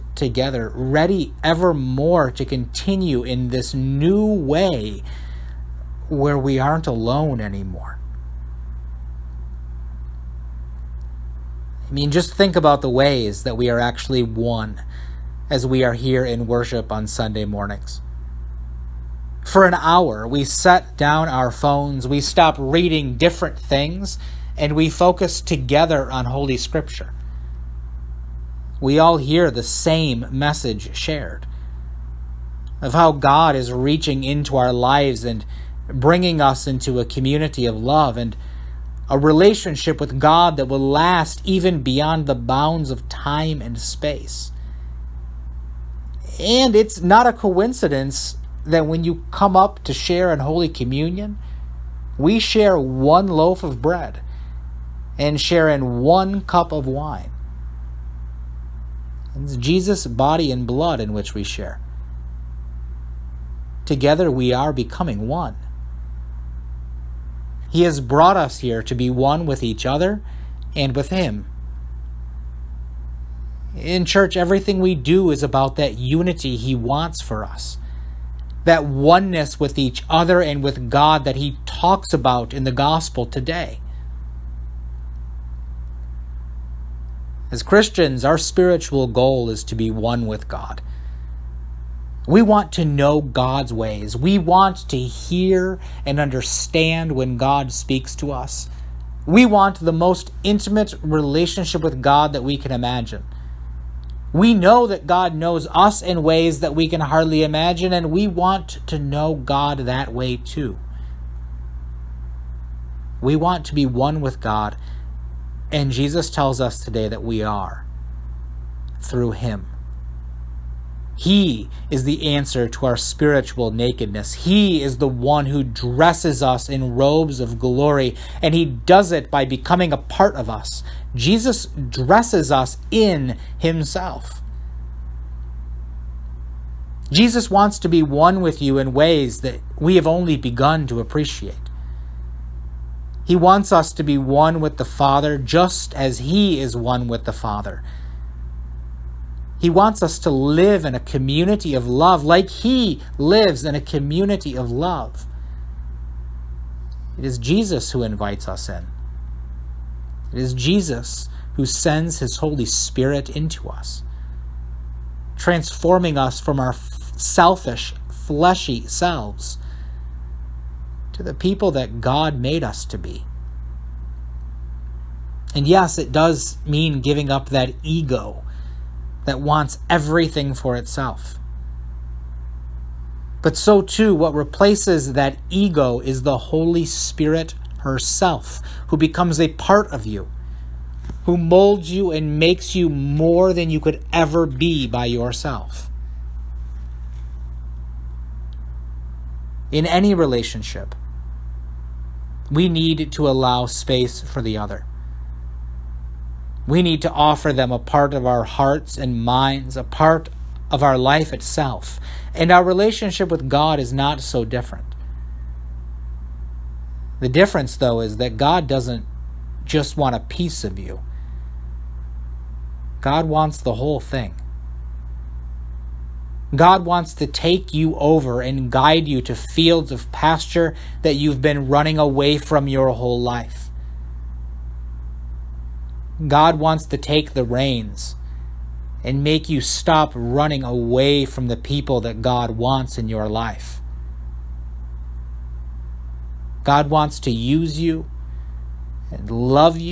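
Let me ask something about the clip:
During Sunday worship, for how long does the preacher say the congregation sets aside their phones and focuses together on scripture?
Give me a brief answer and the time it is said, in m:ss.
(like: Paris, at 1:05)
An hour, at 0:19.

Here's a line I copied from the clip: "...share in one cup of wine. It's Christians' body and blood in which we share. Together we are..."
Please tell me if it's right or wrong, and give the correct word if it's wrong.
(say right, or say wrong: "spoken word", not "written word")
wrong: "Jesus", not "Christians".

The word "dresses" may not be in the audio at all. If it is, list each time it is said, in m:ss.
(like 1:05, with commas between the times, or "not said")
2:05, 2:11.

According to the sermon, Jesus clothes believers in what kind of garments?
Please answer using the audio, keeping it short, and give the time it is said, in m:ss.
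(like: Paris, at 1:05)
Robes of glory, at 2:06.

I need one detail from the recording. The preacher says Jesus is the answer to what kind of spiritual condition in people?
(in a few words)
Spiritual nakedness.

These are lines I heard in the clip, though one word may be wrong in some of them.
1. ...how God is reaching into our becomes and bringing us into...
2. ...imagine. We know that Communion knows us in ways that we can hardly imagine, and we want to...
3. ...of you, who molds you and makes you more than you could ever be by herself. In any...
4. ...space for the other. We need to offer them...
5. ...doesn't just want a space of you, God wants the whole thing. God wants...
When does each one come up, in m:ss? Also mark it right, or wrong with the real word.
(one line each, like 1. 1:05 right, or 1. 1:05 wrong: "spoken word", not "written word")
1. 0:32 wrong: "lives", not "becomes"
2. 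1:42 wrong: "God", not "Communion"
3. 3:09 wrong: "yourself", not "herself"
4. 3:23 right
5. 3:38 wrong: "piece", not "space".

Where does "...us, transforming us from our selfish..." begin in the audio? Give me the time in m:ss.
2:43.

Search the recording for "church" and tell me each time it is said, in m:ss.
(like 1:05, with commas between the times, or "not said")
1:14.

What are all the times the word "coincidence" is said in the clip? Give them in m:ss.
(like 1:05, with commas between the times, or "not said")
0:47.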